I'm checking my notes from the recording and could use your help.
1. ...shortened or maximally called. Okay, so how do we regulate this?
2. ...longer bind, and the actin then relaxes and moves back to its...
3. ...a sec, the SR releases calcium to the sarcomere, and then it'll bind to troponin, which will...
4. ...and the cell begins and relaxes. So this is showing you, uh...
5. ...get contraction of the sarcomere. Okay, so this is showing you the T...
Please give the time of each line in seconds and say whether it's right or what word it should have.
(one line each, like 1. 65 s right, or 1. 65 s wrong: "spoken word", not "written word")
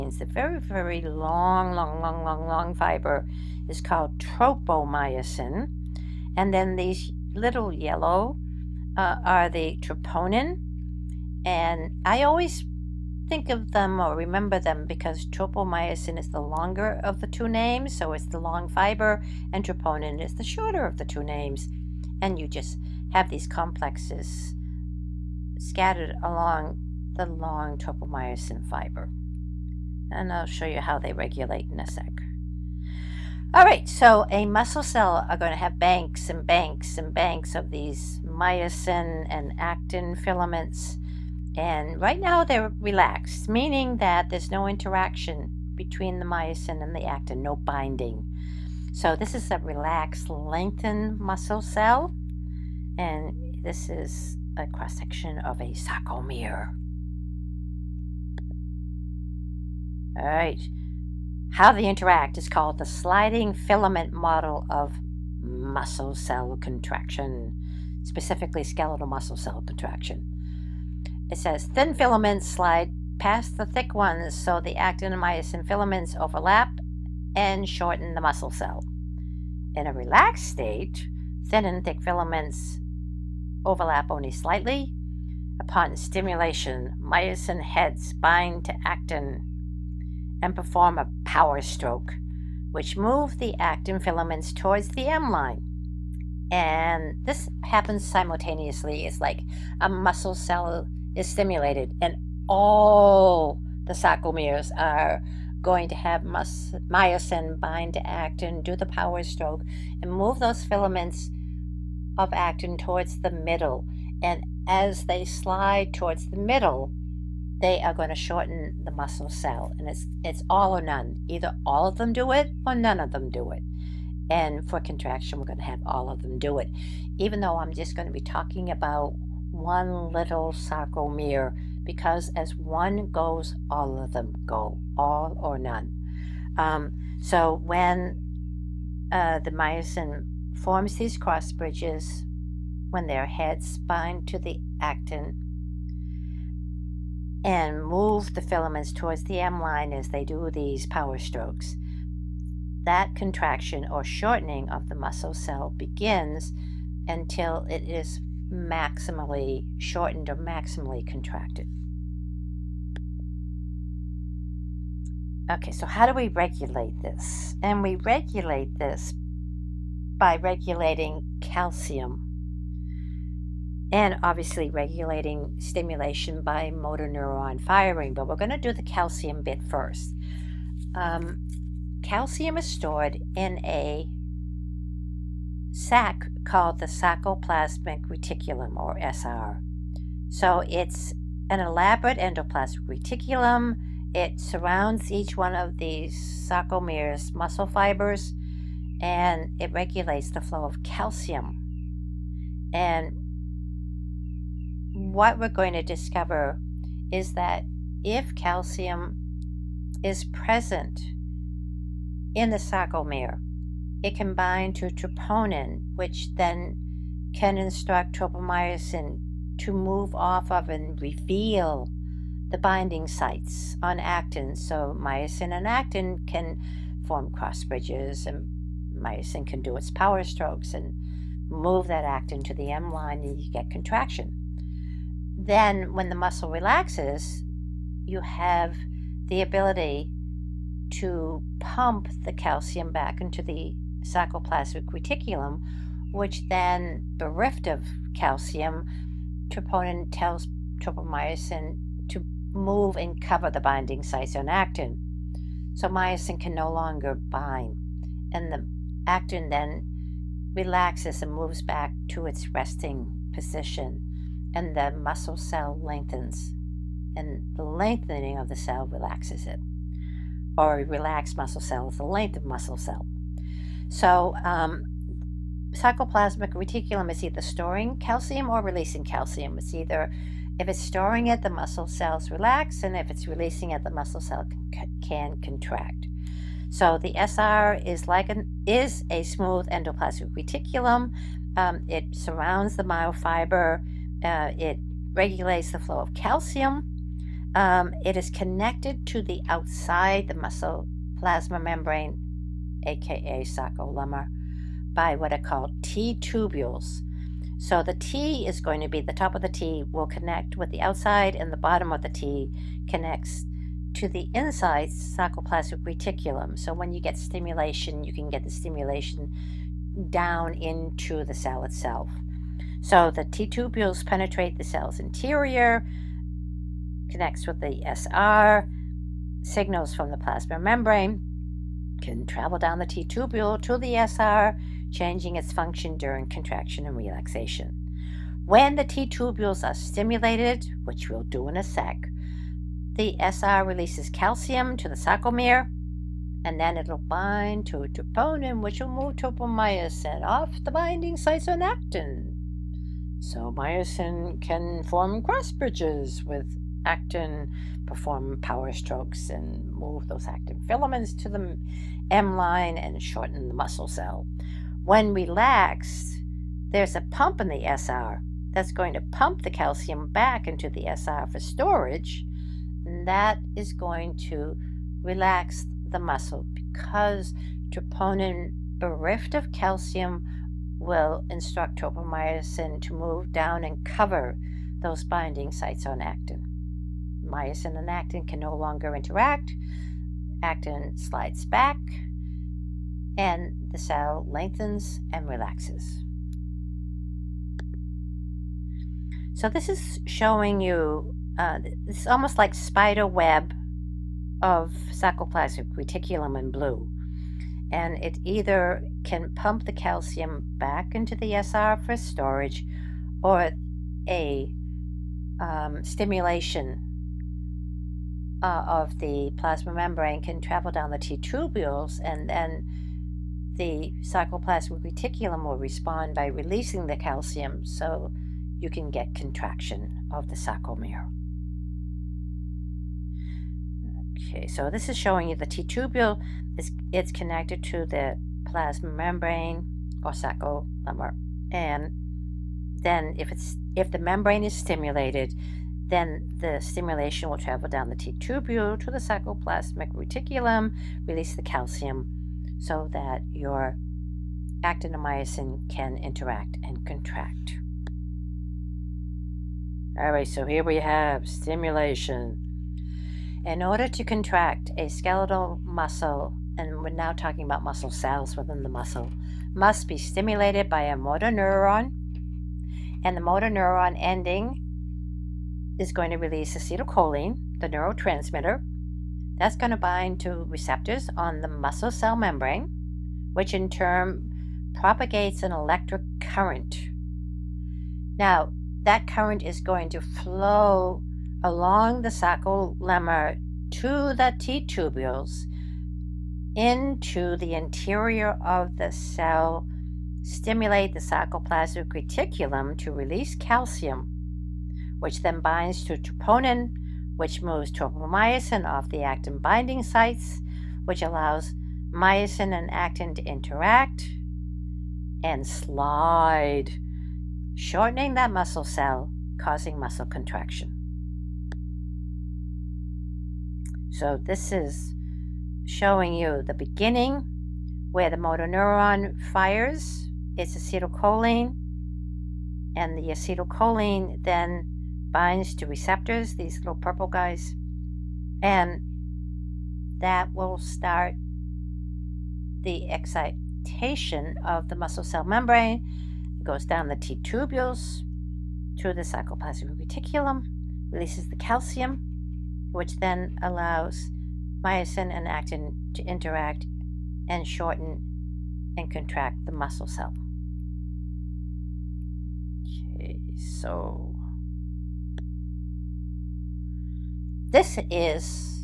1. 159 s wrong: "contracted", not "called"
2. 256 s right
3. 341 s right
4. 393 s wrong: "lengthens", not "begins"
5. 428 s right.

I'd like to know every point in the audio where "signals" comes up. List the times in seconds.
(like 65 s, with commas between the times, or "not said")
329 s.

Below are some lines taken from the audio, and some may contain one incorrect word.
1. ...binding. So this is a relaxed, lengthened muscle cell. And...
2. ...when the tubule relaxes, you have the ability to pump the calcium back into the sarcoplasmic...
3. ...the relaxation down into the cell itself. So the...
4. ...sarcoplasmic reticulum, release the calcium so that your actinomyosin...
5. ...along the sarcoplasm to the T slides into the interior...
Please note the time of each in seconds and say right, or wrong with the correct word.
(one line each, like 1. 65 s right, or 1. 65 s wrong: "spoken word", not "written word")
1. 47 s right
2. 235 s wrong: "muscle", not "tubule"
3. 318 s wrong: "stimulation", not "relaxation"
4. 448 s right
5. 491 s wrong: "tubules", not "slides".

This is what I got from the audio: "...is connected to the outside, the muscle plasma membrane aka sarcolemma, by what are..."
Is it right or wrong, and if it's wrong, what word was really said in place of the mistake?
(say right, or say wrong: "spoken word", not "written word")
right.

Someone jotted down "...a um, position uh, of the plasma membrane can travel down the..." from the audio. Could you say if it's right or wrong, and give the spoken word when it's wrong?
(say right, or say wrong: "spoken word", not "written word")
wrong: "stimulation", not "position".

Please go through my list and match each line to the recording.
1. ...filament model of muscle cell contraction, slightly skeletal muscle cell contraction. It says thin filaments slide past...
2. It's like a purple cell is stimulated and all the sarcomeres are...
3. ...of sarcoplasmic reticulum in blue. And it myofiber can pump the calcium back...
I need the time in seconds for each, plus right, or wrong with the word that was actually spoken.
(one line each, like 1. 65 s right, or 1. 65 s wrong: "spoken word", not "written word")
1. 63 s wrong: "specifically", not "slightly"
2. 99 s wrong: "muscle", not "purple"
3. 404 s wrong: "either", not "myofiber".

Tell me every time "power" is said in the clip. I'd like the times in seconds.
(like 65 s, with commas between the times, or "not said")
91 s, 108 s, 150 s, 229 s, 358 s.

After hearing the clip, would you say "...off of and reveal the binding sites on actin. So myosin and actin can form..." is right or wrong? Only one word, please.
right.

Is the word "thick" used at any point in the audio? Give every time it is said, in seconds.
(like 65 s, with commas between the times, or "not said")
73 s, 81 s.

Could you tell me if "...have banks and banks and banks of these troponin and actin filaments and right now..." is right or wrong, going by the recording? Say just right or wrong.
wrong.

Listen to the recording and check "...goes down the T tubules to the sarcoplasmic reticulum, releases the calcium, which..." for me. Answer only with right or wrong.
right.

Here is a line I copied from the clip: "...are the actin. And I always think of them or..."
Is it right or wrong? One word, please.
wrong.